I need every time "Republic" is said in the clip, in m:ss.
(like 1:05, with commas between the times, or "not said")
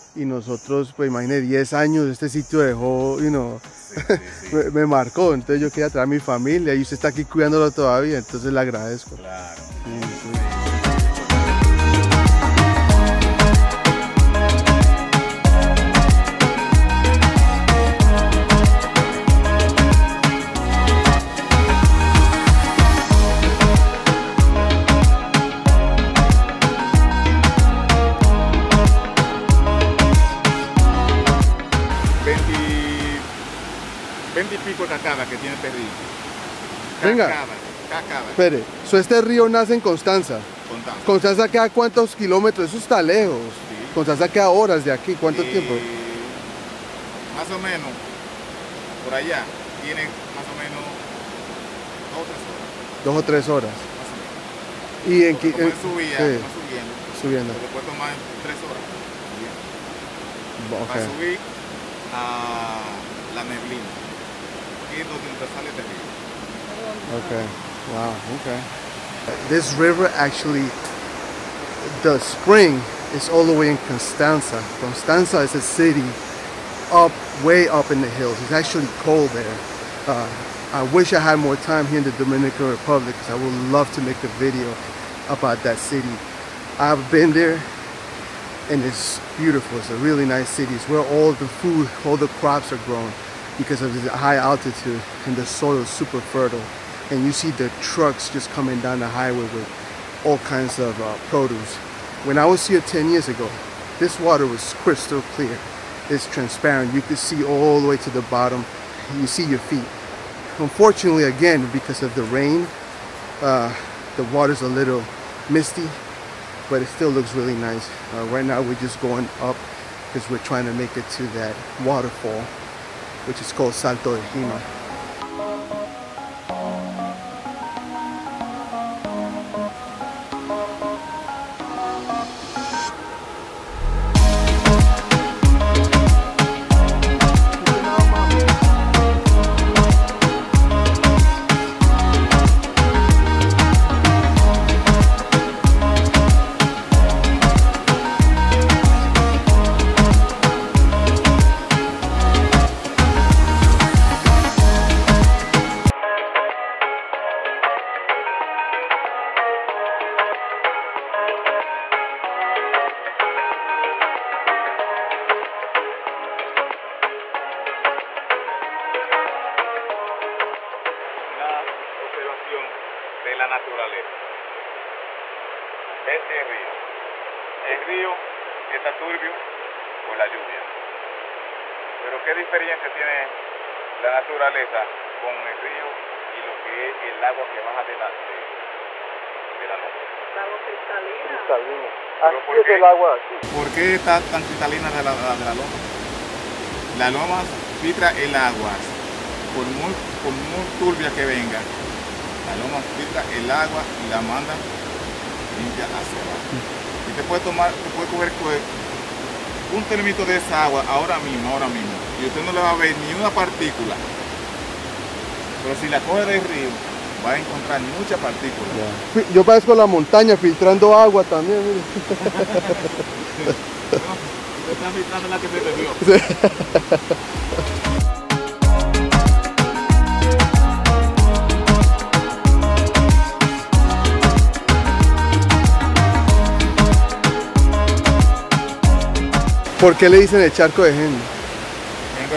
1:22.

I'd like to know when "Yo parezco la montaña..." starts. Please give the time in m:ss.
3:39.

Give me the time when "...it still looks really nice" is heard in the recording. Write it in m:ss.
1:56.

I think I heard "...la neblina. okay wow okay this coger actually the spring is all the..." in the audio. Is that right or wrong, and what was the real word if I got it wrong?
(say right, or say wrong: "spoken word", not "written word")
wrong: "river", not "coger".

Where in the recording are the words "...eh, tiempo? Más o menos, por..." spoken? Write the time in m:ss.
0:45.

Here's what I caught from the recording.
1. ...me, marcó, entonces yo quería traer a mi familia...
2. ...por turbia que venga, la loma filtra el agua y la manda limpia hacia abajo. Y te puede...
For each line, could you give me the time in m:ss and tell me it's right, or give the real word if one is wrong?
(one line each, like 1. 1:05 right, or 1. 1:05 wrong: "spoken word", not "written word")
1. 0:04 right
2. 3:20 right.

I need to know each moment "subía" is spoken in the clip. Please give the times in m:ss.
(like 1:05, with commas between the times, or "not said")
0:55.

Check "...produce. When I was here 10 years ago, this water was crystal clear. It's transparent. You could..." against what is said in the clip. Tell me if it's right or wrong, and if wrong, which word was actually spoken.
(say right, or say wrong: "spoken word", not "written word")
right.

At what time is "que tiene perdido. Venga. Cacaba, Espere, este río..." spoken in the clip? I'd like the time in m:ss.
0:35.